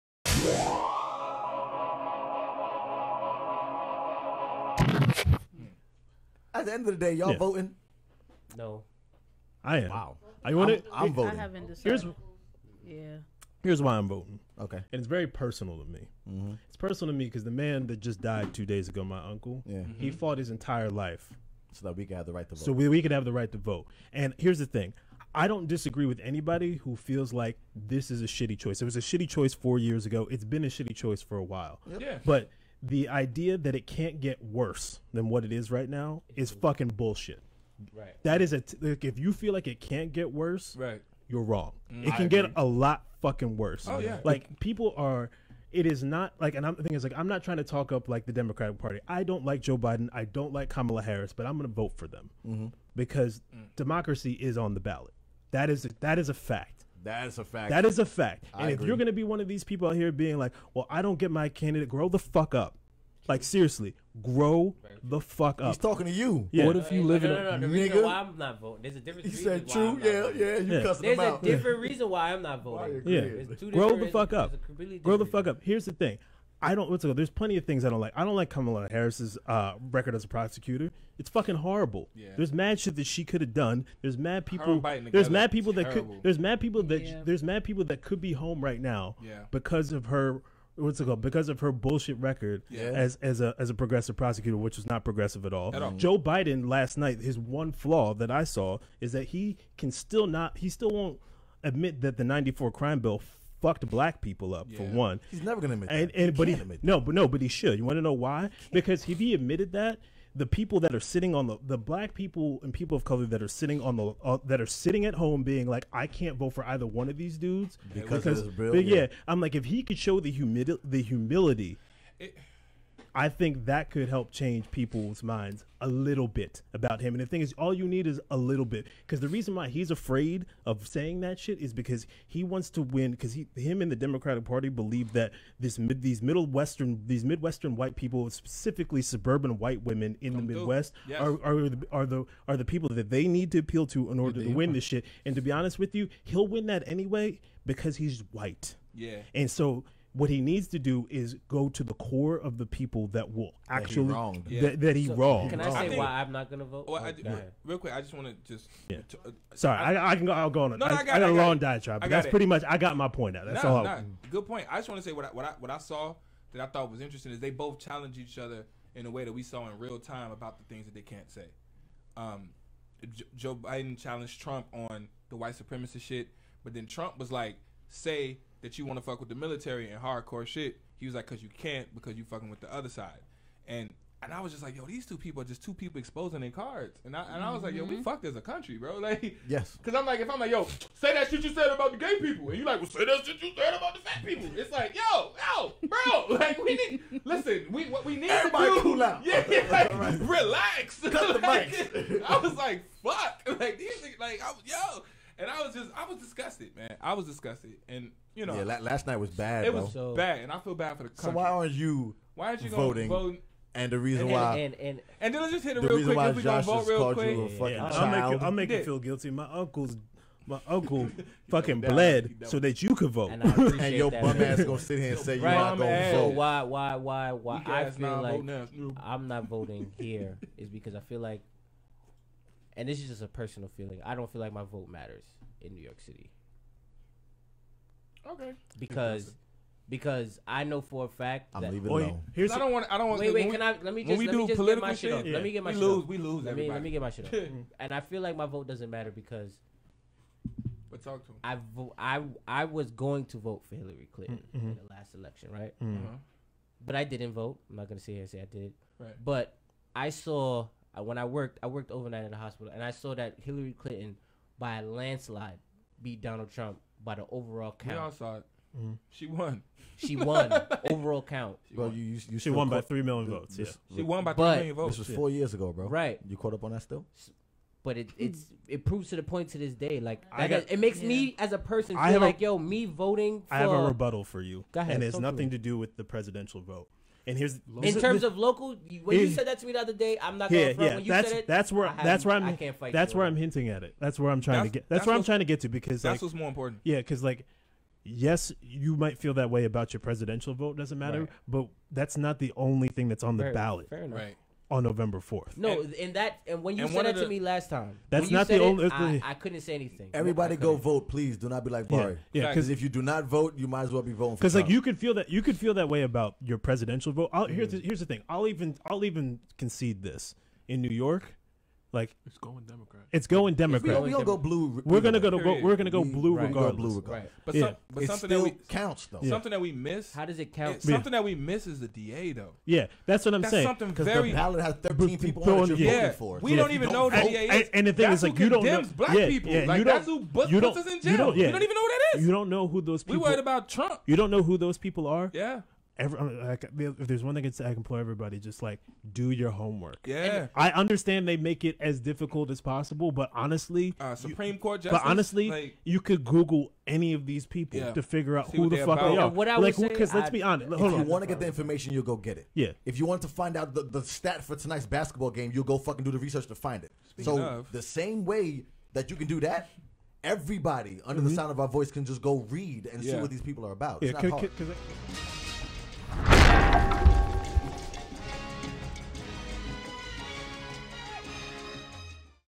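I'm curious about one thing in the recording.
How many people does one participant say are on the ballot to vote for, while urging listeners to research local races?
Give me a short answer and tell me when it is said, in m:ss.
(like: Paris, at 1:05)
13, at 5:34.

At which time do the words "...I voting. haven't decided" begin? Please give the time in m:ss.
0:11.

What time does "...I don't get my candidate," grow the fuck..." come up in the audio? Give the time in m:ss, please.
1:00.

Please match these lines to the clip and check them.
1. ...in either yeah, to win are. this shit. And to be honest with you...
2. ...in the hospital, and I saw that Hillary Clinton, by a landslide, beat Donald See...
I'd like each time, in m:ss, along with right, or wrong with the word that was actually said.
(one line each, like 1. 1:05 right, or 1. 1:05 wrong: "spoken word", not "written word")
1. 2:24 wrong: "order", not "either"
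2. 4:22 wrong: "Trump", not "See".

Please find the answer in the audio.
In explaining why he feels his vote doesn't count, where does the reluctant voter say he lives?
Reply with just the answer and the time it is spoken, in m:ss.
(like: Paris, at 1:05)
New York City, at 3:55.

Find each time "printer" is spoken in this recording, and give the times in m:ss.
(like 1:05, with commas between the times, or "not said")
not said.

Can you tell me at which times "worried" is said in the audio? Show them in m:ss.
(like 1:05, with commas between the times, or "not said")
5:43.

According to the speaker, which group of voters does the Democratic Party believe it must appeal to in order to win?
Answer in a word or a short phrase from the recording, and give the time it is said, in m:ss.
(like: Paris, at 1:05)
Suburban white women, at 2:19.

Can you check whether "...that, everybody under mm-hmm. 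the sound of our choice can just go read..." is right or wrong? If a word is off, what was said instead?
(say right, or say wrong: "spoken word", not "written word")
wrong: "voice", not "choice".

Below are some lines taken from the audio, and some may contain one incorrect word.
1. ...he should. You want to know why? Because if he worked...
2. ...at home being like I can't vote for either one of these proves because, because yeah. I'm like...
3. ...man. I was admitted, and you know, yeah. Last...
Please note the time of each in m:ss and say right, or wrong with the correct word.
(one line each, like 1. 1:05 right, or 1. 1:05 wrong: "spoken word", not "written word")
1. 1:47 wrong: "admitted", not "worked"
2. 1:55 wrong: "dudes", not "proves"
3. 3:26 wrong: "disgusted", not "admitted".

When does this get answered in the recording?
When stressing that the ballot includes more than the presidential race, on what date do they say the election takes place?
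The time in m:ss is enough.
5:04.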